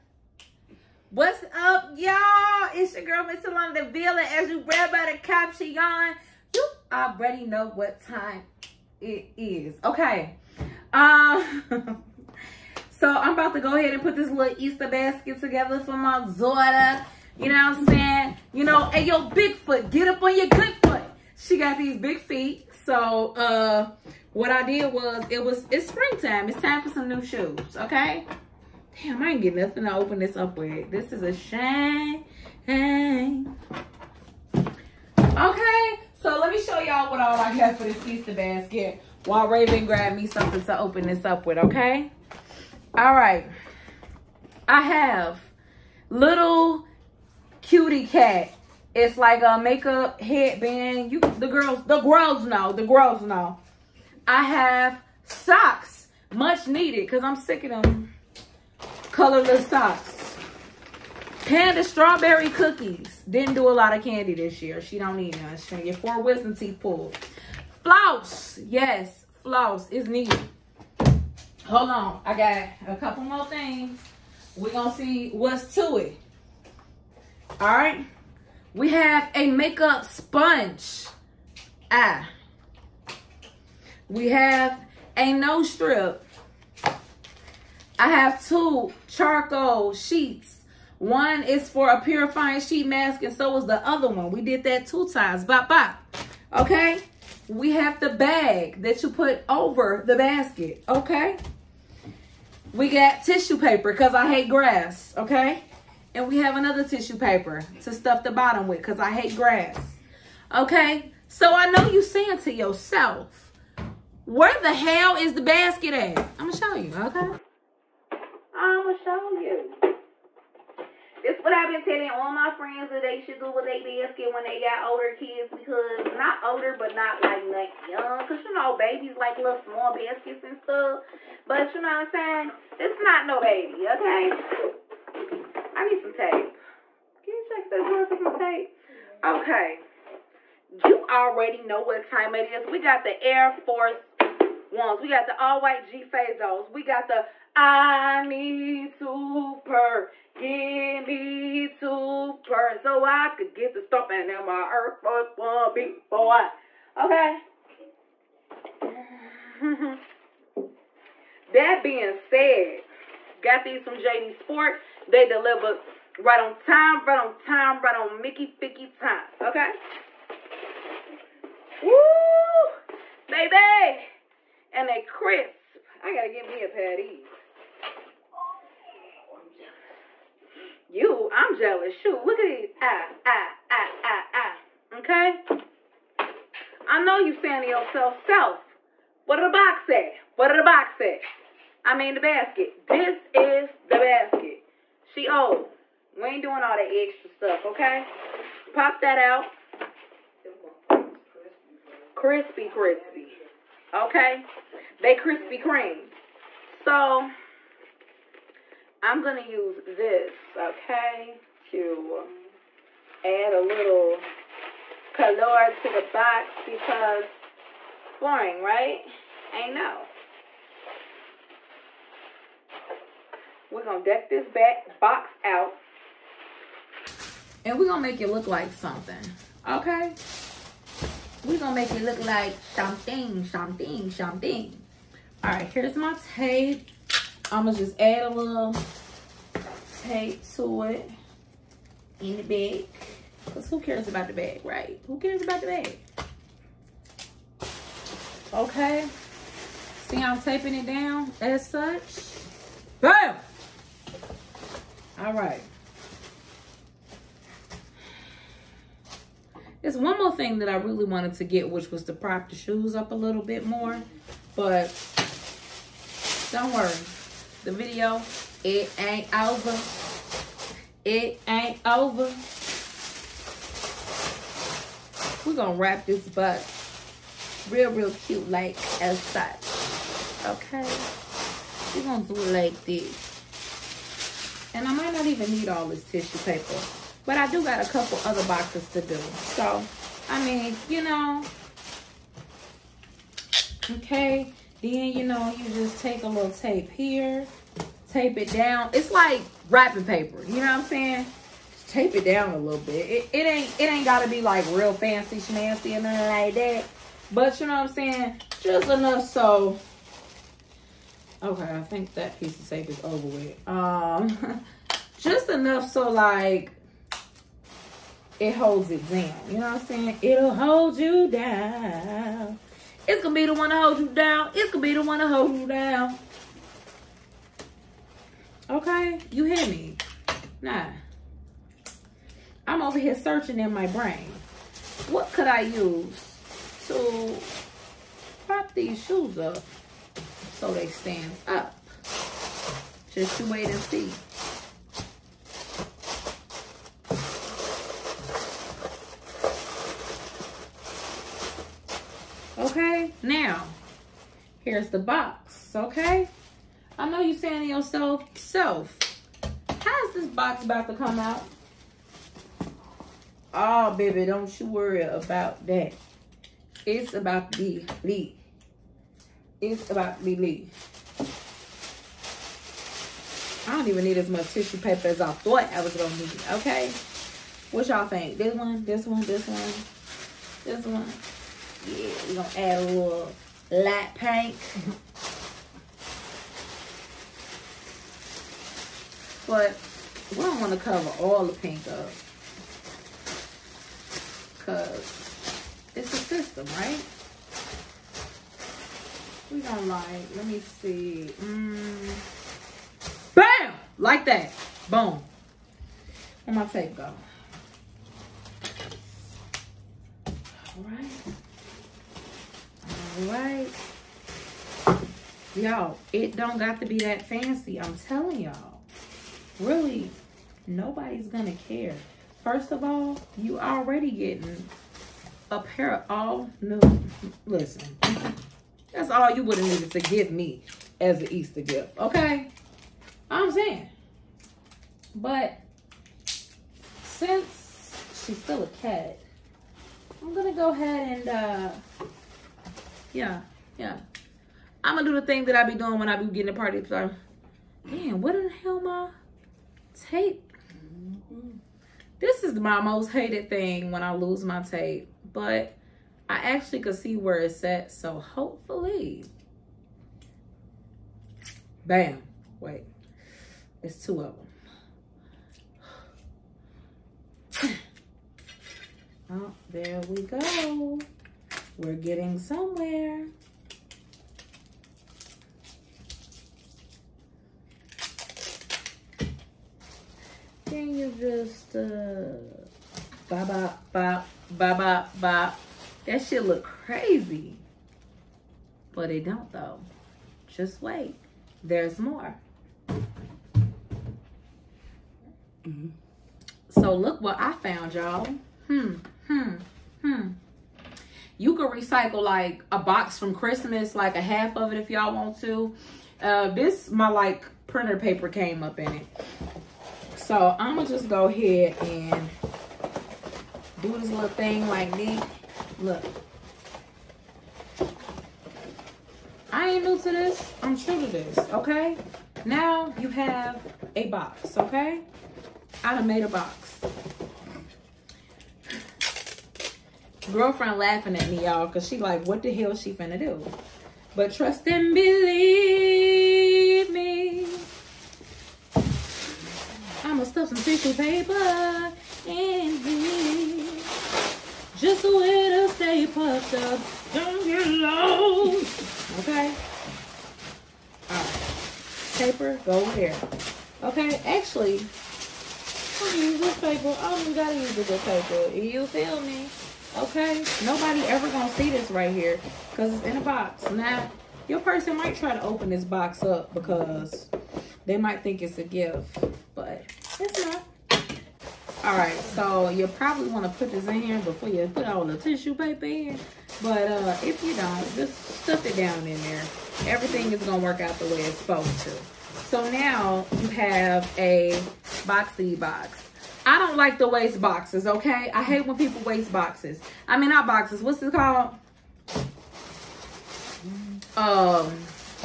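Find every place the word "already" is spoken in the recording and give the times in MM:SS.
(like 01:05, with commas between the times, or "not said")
00:07, 02:21, 07:03.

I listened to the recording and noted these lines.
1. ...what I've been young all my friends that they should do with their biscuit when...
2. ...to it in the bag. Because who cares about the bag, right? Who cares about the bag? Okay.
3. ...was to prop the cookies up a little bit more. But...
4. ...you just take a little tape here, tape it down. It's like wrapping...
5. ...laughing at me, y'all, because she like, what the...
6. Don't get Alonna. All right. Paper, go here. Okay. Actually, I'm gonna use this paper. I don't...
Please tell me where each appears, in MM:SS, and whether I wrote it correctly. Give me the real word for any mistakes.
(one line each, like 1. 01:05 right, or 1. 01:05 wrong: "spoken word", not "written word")
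1. 02:01 wrong: "telling", not "young"
2. 04:00 right
3. 04:21 wrong: "shoes", not "cookies"
4. 04:55 right
5. 08:50 right
6. 09:06 wrong: "Okay", not "Alonna".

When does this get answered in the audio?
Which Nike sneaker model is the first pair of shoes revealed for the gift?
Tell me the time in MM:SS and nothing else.
02:23.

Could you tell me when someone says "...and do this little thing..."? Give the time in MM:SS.
08:31.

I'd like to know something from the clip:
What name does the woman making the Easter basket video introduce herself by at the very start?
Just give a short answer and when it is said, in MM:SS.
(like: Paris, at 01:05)
Alonna Deville, at 00:03.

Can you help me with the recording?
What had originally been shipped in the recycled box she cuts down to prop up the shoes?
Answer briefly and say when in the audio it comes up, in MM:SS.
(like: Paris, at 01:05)
Printer paper, at 08:27.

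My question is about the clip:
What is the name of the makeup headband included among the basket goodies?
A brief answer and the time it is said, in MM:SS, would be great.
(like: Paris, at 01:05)
Cutie cat, at 00:47.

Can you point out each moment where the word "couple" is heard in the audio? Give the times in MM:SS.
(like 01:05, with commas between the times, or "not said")
01:12, 04:47.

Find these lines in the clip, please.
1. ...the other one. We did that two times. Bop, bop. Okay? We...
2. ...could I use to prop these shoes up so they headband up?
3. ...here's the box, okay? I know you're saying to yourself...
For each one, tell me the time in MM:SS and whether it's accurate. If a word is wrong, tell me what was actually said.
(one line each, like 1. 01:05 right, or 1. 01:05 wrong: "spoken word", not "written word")
1. 01:33 right
2. 05:35 wrong: "stand", not "headband"
3. 05:54 right.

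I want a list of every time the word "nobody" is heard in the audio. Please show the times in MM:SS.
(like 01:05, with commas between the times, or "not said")
07:00, 09:20.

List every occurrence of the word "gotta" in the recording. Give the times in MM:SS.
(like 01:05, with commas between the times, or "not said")
02:56, 09:17.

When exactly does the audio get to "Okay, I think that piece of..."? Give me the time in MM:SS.
05:11.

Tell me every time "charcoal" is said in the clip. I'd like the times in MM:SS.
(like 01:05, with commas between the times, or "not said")
01:29.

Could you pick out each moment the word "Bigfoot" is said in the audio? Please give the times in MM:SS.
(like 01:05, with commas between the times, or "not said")
00:19.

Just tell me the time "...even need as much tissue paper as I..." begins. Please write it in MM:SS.
06:13.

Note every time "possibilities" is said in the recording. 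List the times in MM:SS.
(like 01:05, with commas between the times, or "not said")
not said.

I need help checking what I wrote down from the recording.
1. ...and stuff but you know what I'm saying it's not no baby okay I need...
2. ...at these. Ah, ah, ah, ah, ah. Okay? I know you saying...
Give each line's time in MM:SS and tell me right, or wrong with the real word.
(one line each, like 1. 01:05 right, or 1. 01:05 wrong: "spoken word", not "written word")
1. 02:10 right
2. 03:02 right.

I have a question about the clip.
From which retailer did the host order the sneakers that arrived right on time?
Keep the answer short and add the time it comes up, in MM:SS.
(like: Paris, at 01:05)
JD Sport, at 02:43.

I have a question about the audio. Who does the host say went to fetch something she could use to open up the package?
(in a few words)
Raven.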